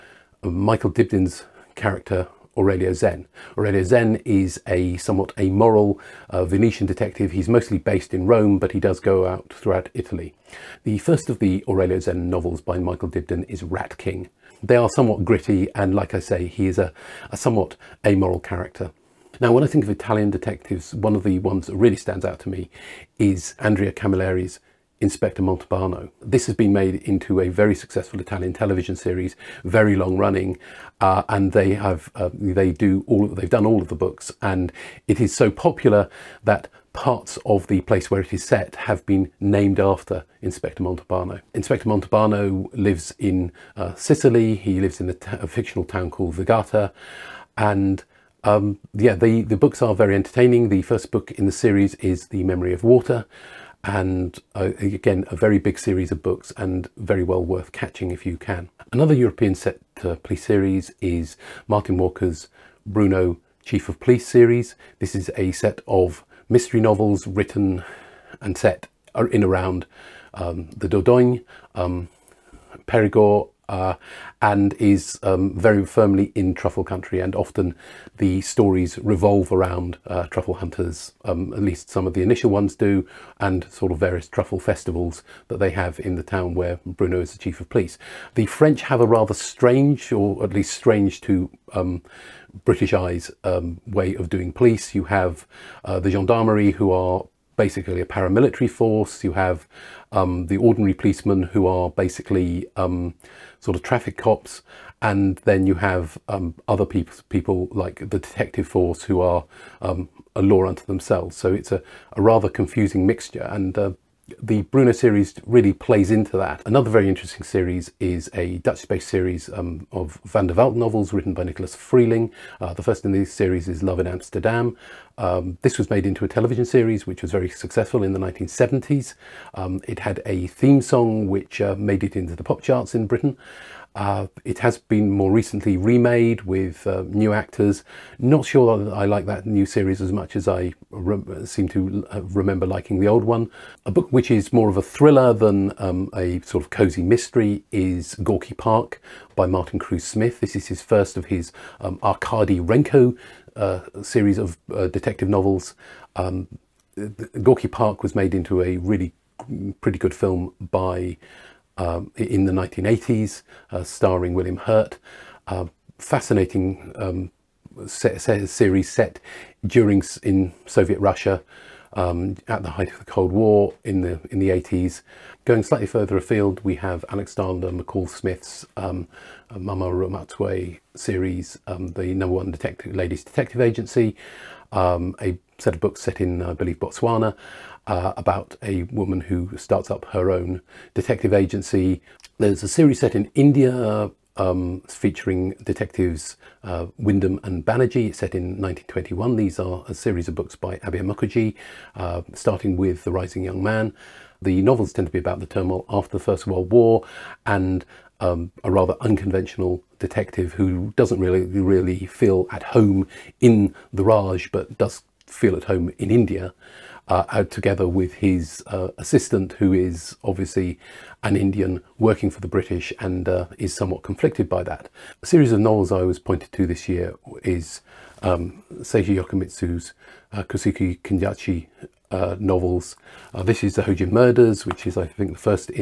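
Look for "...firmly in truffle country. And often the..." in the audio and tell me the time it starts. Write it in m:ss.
1:15.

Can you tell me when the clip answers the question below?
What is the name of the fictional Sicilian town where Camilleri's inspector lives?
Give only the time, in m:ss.
0:46.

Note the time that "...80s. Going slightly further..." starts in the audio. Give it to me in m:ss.
2:54.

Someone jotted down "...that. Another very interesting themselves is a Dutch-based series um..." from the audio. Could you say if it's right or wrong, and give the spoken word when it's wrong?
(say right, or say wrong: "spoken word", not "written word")
wrong: "series", not "themselves".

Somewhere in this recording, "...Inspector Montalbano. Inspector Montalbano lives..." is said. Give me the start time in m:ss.
0:40.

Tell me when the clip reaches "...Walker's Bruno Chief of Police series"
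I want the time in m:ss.
1:01.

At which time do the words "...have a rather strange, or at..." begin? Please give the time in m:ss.
1:28.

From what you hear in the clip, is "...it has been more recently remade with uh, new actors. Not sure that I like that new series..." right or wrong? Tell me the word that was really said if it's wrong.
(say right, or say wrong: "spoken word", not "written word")
right.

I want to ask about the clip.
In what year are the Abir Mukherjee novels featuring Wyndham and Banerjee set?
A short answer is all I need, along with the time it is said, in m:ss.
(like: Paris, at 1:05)
1921, at 3:18.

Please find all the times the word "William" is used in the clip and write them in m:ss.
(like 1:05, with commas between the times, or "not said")
2:44.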